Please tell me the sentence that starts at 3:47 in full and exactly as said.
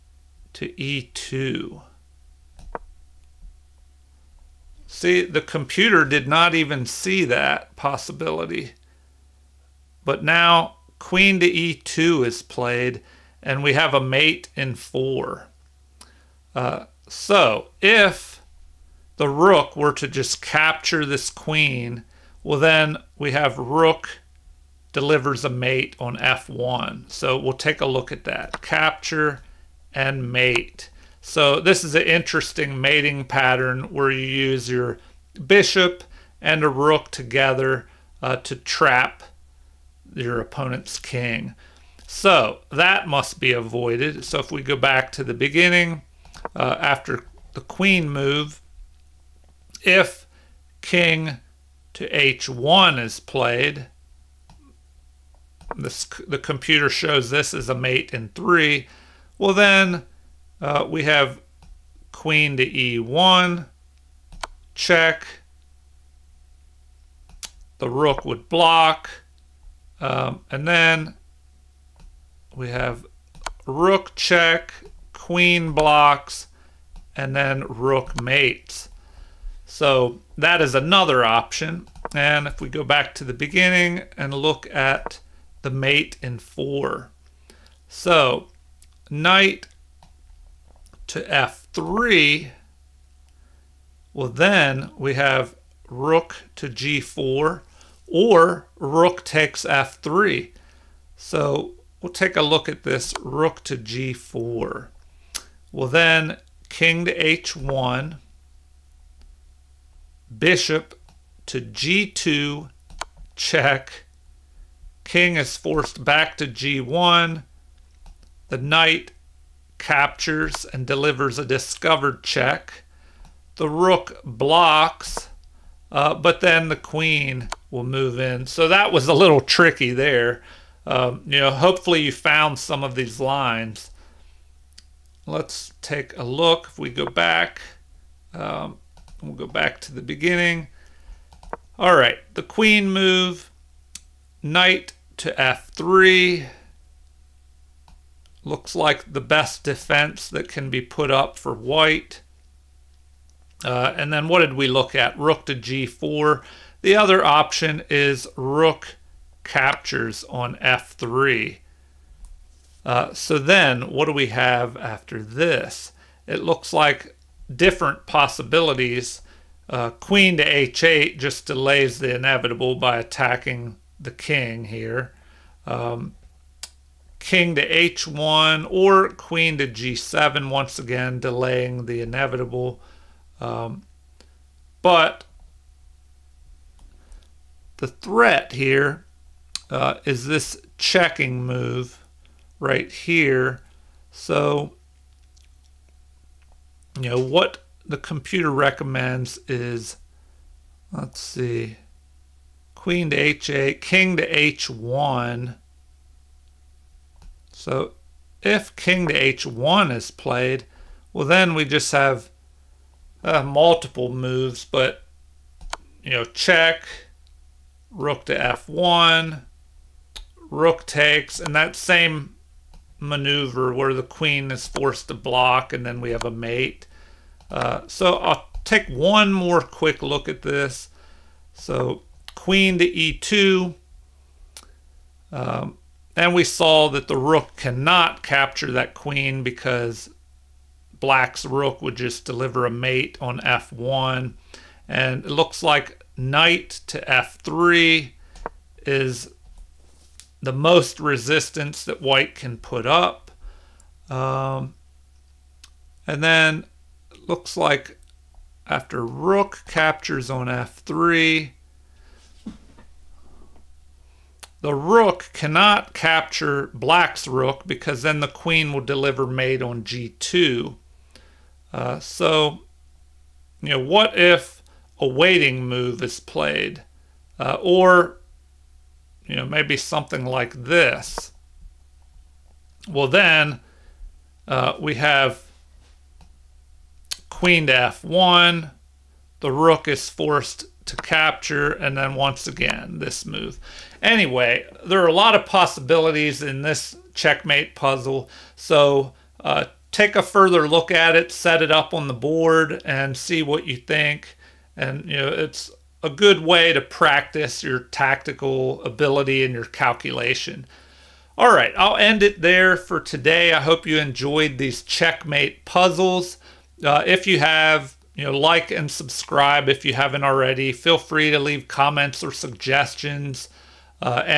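Uh, so I'll take one more quick look at this.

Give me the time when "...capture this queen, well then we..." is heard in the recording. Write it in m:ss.
0:20.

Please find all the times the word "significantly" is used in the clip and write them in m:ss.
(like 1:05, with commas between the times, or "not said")
not said.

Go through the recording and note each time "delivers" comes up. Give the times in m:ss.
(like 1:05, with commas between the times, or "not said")
0:24, 2:00, 4:02, 4:28.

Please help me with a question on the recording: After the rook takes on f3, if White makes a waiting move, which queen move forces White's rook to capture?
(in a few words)
Queen to f1.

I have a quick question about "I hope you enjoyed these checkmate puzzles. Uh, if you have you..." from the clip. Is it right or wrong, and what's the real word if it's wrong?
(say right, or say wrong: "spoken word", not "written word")
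right.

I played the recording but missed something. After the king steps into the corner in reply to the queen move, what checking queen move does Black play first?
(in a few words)
Queen to e1.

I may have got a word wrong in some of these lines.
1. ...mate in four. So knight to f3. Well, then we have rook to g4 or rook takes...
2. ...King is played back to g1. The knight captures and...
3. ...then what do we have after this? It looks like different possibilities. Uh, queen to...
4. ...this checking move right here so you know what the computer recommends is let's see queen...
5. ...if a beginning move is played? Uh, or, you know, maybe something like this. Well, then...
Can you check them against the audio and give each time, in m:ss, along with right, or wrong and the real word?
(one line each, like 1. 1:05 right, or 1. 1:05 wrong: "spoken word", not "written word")
1. 1:25 right
2. 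1:55 wrong: "forced", not "played"
3. 2:43 right
4. 3:10 right
5. 4:34 wrong: "waiting", not "beginning".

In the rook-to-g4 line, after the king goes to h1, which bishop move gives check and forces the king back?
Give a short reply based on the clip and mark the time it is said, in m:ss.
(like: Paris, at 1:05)
Bishop to g2, at 1:50.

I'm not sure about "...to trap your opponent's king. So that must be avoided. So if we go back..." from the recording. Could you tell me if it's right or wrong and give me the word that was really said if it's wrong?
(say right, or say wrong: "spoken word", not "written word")
right.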